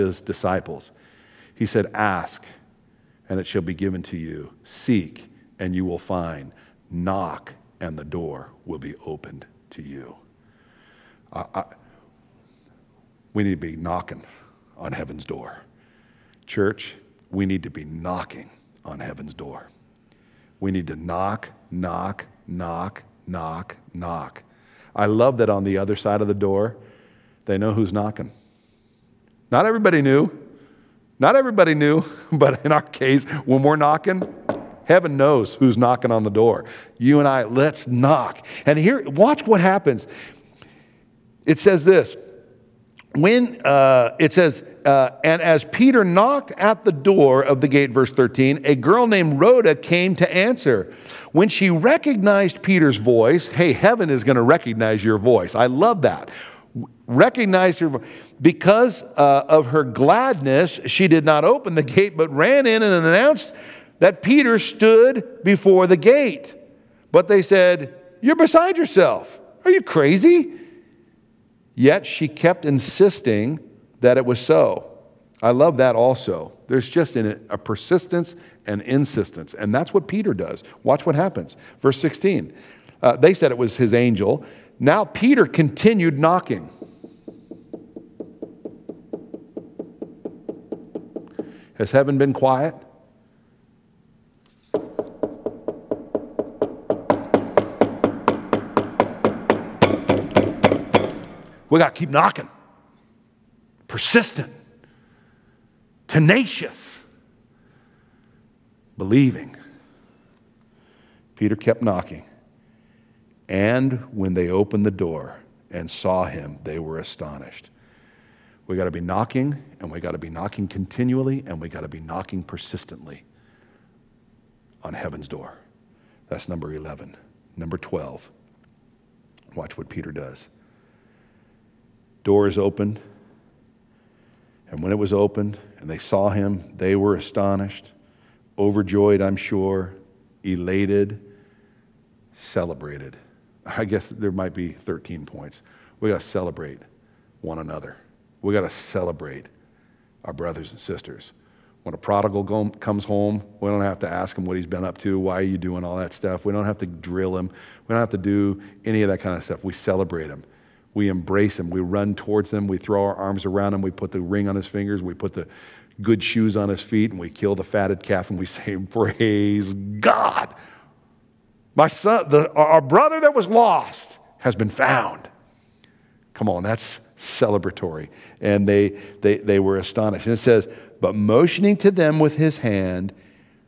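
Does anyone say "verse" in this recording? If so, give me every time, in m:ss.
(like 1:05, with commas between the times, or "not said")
0:47, 1:21.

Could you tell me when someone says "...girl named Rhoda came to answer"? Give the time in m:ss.
0:48.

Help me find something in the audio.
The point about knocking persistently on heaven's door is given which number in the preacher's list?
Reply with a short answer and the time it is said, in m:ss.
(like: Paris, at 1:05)
11, at 2:06.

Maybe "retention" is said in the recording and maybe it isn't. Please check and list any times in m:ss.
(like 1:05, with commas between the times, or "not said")
not said.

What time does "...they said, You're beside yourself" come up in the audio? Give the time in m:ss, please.
1:07.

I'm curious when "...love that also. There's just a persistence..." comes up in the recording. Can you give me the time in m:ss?
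1:15.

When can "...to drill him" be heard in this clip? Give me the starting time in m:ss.
2:36.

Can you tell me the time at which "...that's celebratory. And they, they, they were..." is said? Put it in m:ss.
2:56.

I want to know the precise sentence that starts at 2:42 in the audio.
We throw our arms around him.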